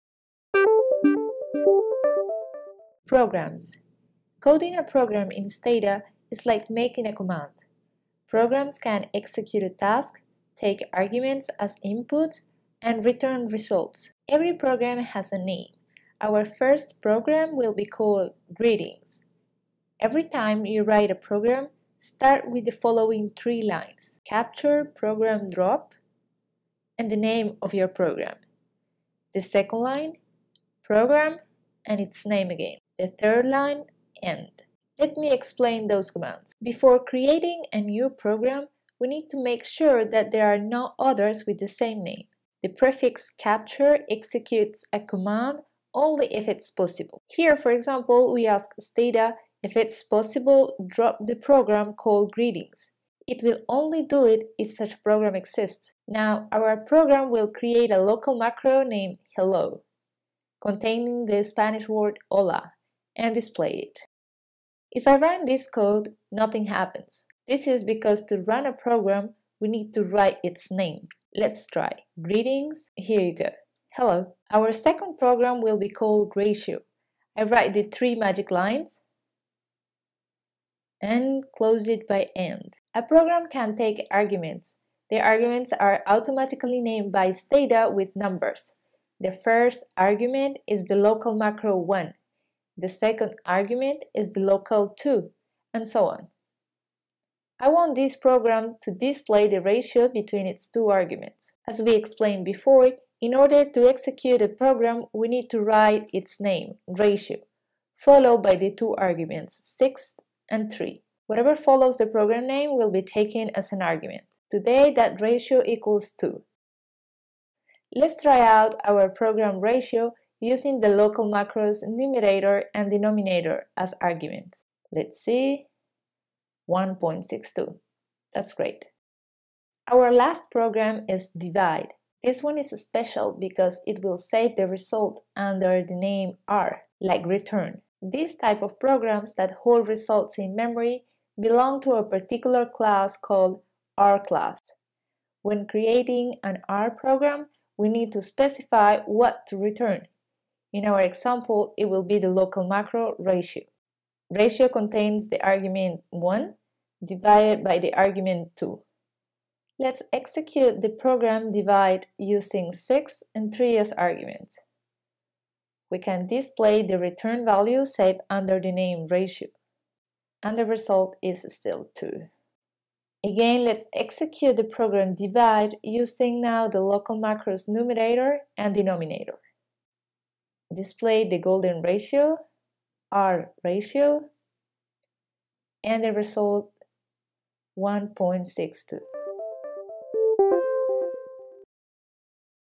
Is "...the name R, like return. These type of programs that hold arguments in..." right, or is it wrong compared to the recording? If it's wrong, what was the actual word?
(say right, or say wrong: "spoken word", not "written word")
wrong: "results", not "arguments".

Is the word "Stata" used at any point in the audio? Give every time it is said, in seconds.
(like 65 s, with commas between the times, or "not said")
5 s, 48 s, 87 s.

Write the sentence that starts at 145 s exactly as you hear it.
When creating an R program, we need to specify what to return.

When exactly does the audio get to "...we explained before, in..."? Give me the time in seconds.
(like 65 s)
101 s.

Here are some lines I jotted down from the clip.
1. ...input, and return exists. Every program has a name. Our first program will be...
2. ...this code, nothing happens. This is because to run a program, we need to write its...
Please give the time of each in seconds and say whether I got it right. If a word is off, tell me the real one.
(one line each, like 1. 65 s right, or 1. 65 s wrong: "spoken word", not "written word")
1. 11 s wrong: "results", not "exists"
2. 65 s right.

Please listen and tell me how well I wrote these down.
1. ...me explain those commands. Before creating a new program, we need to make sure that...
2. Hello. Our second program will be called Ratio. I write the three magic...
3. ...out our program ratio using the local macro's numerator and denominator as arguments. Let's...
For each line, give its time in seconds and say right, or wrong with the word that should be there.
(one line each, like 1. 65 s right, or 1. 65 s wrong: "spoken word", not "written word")
1. 35 s right
2. 73 s right
3. 118 s right.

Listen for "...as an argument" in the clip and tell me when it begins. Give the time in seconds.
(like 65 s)
113 s.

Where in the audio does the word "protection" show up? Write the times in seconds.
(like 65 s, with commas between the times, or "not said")
not said.